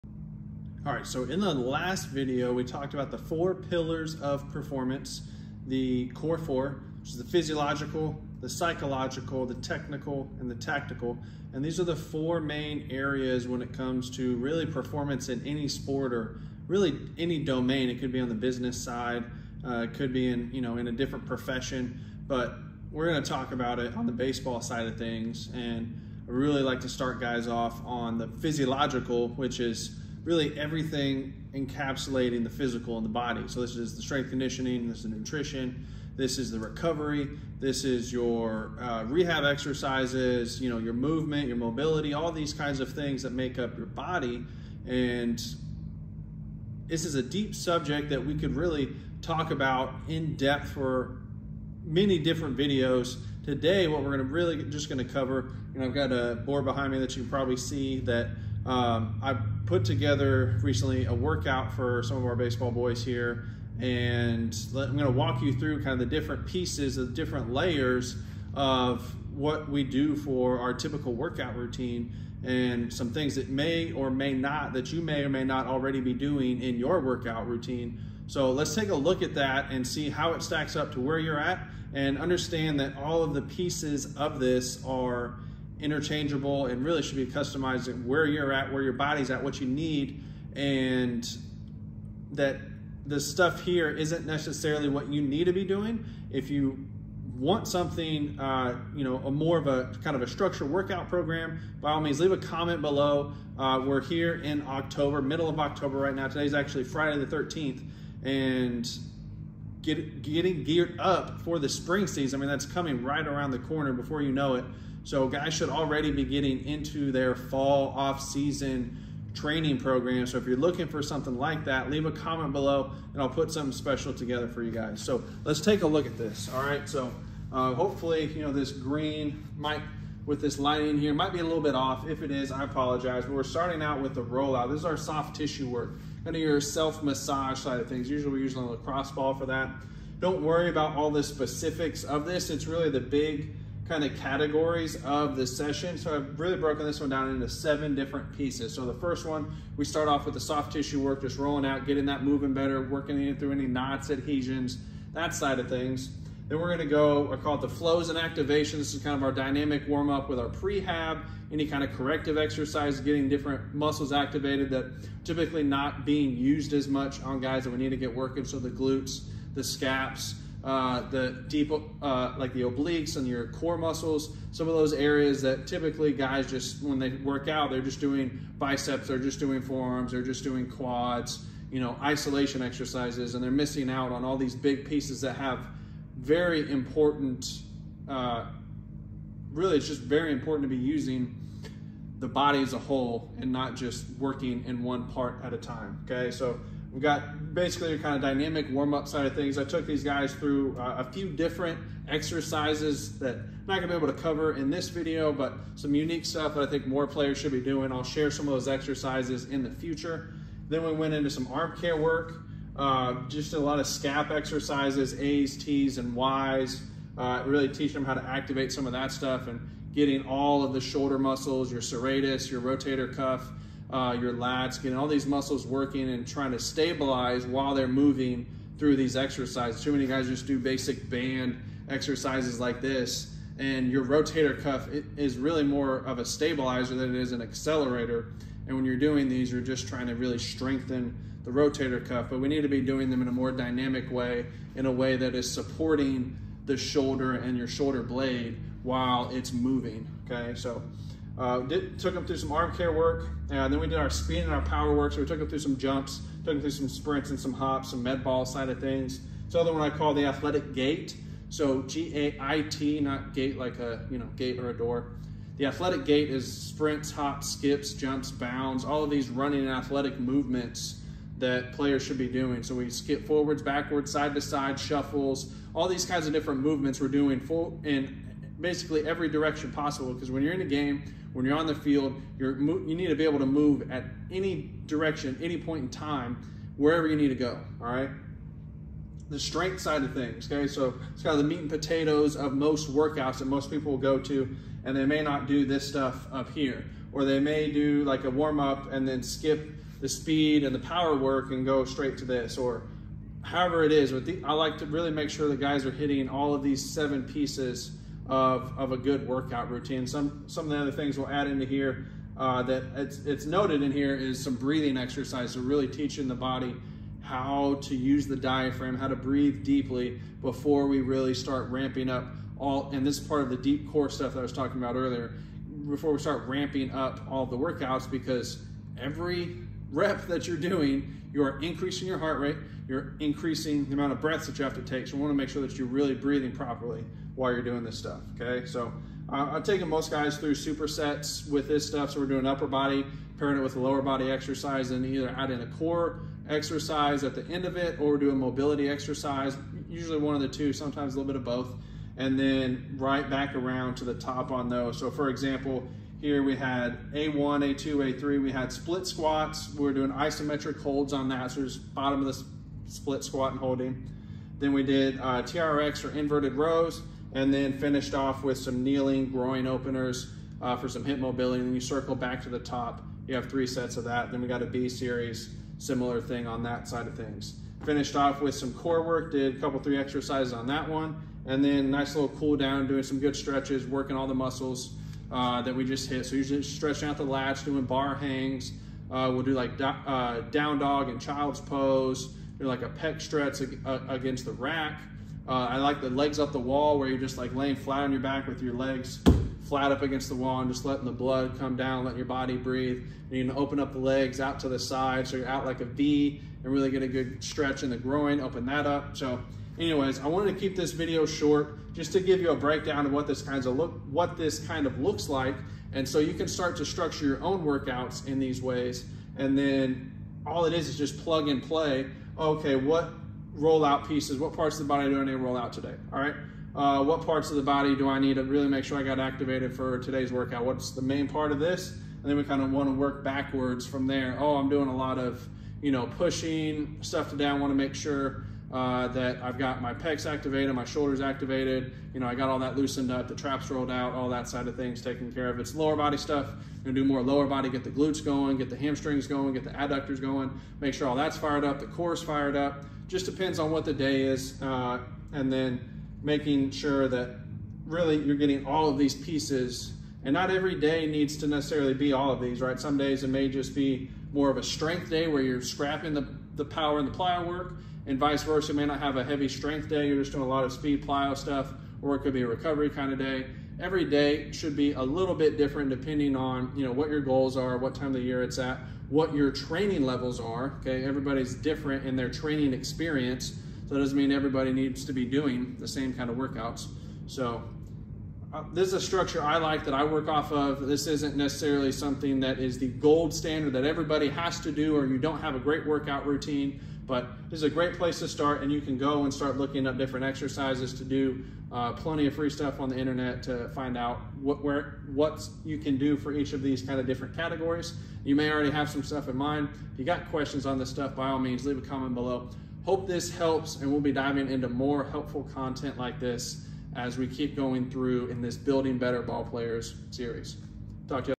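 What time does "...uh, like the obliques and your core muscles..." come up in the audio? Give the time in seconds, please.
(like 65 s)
172 s.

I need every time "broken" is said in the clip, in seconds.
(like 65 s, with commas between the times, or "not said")
146 s.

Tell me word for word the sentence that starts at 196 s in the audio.
Okay, so we've got basically a kind of dynamic warm-up side of things.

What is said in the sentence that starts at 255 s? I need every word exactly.
So we took them through some jumps, took them through some sprints and some hops, some med ball side of things.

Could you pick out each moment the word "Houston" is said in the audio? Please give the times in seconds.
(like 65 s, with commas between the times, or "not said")
not said.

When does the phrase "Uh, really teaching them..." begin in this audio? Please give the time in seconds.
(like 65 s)
217 s.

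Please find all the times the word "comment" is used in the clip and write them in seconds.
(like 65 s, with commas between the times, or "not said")
102 s, 122 s, 511 s.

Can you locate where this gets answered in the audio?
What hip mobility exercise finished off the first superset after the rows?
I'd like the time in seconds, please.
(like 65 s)
368 s.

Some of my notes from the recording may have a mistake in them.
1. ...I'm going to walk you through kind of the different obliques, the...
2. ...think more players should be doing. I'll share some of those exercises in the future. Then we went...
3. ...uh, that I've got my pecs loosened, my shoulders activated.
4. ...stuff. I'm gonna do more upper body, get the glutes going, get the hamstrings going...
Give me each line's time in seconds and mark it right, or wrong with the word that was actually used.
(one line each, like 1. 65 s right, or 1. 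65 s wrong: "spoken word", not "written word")
1. 64 s wrong: "pieces", not "obliques"
2. 206 s right
3. 438 s wrong: "activated", not "loosened"
4. 446 s wrong: "lower", not "upper".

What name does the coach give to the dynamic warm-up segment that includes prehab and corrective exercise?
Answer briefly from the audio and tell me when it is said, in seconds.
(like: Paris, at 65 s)
Flows and activation, at 157 s.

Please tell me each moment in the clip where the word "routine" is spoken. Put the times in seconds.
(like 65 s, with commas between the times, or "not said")
71 s, 77 s, 309 s, 496 s.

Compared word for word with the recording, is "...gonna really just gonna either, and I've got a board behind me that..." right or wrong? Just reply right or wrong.
wrong.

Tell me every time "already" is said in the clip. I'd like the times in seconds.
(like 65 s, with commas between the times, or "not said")
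75 s, 115 s, 508 s.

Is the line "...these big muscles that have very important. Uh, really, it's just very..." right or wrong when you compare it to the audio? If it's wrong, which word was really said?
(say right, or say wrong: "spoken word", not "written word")
wrong: "pieces", not "muscles".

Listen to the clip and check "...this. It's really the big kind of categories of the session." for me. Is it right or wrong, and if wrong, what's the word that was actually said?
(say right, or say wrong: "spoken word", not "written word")
right.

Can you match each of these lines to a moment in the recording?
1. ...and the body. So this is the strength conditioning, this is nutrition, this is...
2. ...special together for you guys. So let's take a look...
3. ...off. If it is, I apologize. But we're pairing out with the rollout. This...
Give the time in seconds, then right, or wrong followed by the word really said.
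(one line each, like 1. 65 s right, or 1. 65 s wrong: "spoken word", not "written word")
1. 32 s right
2. 123 s right
3. 131 s wrong: "starting", not "pairing".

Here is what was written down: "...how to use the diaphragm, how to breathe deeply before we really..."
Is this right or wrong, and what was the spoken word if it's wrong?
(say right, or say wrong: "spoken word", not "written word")
right.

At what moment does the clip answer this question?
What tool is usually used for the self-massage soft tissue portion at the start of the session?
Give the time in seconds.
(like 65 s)
138 s.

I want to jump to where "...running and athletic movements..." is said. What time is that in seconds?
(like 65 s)
269 s.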